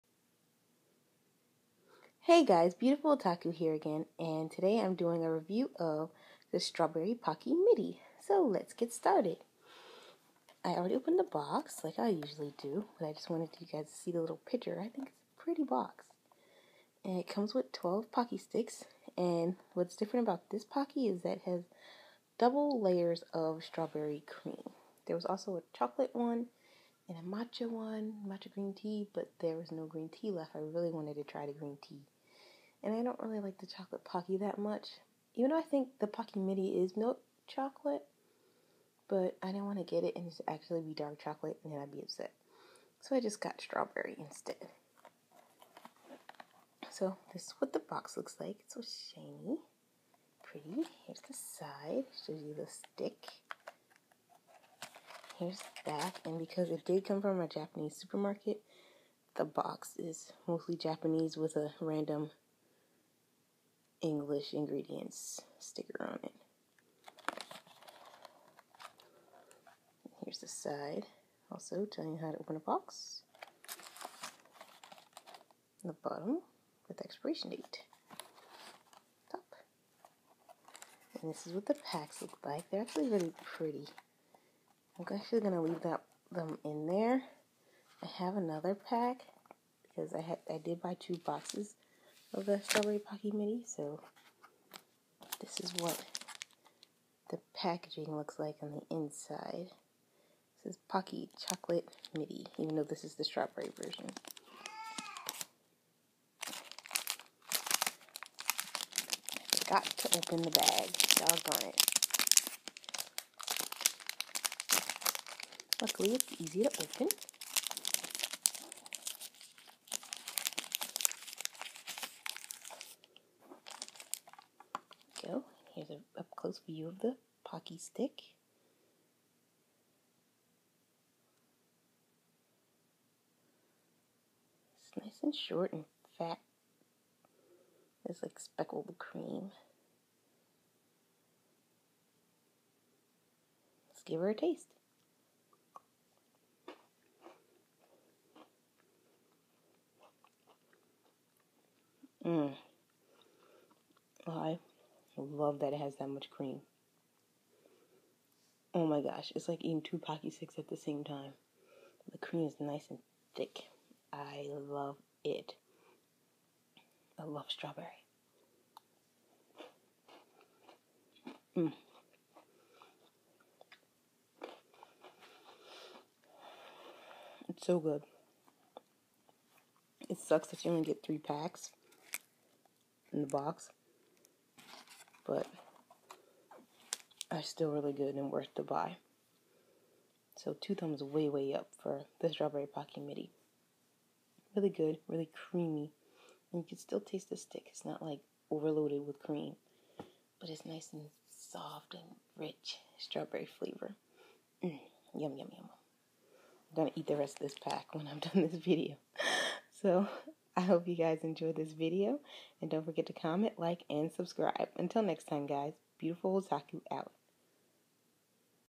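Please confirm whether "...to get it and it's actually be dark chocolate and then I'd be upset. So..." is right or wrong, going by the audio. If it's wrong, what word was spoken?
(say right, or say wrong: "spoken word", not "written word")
right.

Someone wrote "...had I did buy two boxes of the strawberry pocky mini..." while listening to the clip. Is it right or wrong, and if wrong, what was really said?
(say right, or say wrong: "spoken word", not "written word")
right.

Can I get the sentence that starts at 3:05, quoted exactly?
But are still really good and worth the buy.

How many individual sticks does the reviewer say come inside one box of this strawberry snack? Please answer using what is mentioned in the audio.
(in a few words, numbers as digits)
12.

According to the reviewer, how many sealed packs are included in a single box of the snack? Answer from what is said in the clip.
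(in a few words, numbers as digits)
3.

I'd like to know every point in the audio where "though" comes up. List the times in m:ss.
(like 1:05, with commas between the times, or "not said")
0:35, 1:42.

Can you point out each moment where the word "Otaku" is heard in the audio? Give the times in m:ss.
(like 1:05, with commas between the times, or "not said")
0:03, 3:36.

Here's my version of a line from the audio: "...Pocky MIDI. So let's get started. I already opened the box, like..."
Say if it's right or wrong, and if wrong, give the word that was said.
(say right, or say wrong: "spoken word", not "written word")
right.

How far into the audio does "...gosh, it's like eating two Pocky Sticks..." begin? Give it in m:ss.
2:39.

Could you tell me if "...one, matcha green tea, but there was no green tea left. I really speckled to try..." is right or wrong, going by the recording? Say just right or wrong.
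wrong.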